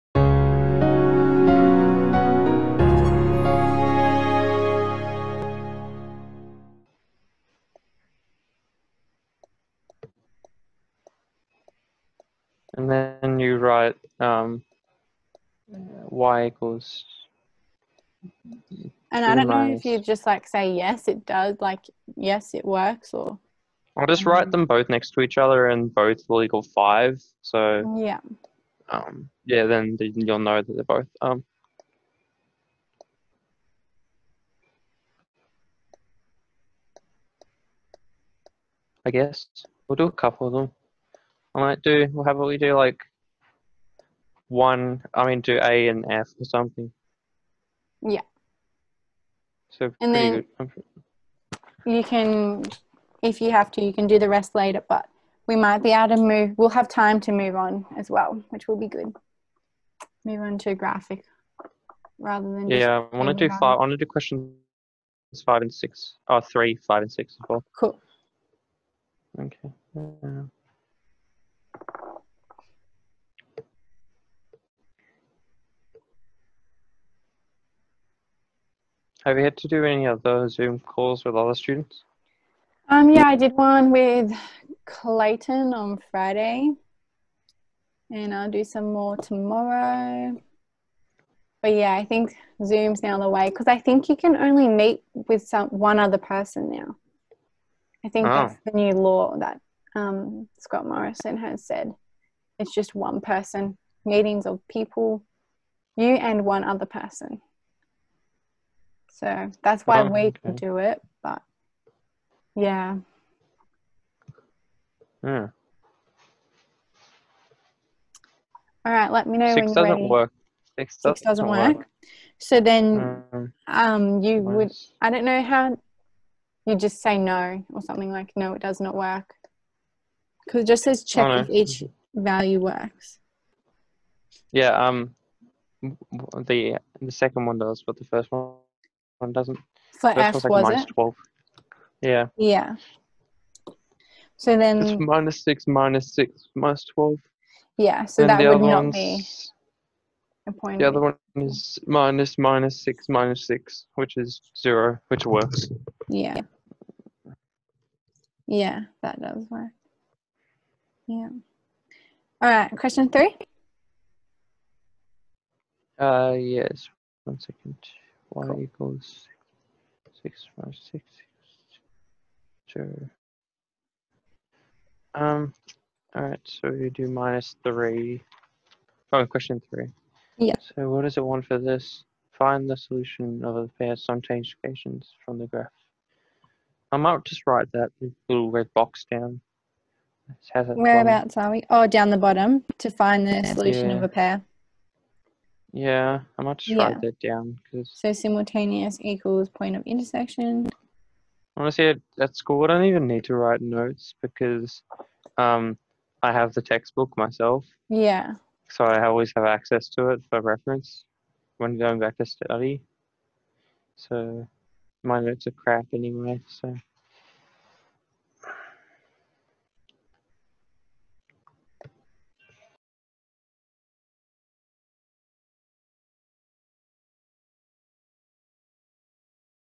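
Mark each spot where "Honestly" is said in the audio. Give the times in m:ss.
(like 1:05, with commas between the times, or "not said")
3:21.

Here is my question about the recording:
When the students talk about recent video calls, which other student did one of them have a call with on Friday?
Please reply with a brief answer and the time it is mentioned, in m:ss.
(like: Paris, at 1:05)
Clayton, at 1:24.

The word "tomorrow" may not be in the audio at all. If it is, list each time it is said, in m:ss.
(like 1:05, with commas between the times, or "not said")
1:29.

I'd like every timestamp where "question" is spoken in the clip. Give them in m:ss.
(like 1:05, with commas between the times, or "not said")
1:04, 2:42, 2:59.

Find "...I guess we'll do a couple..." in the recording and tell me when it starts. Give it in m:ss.
0:39.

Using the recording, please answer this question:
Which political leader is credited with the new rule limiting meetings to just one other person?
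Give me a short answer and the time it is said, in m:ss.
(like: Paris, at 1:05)
Scott Morrison, at 1:40.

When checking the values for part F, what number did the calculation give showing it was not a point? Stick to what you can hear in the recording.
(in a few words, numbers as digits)
-12.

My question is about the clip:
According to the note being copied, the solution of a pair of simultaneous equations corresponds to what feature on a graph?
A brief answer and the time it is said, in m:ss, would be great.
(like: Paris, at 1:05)
point of intersection, at 3:19.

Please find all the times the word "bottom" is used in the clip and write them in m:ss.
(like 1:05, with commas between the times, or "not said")
3:12.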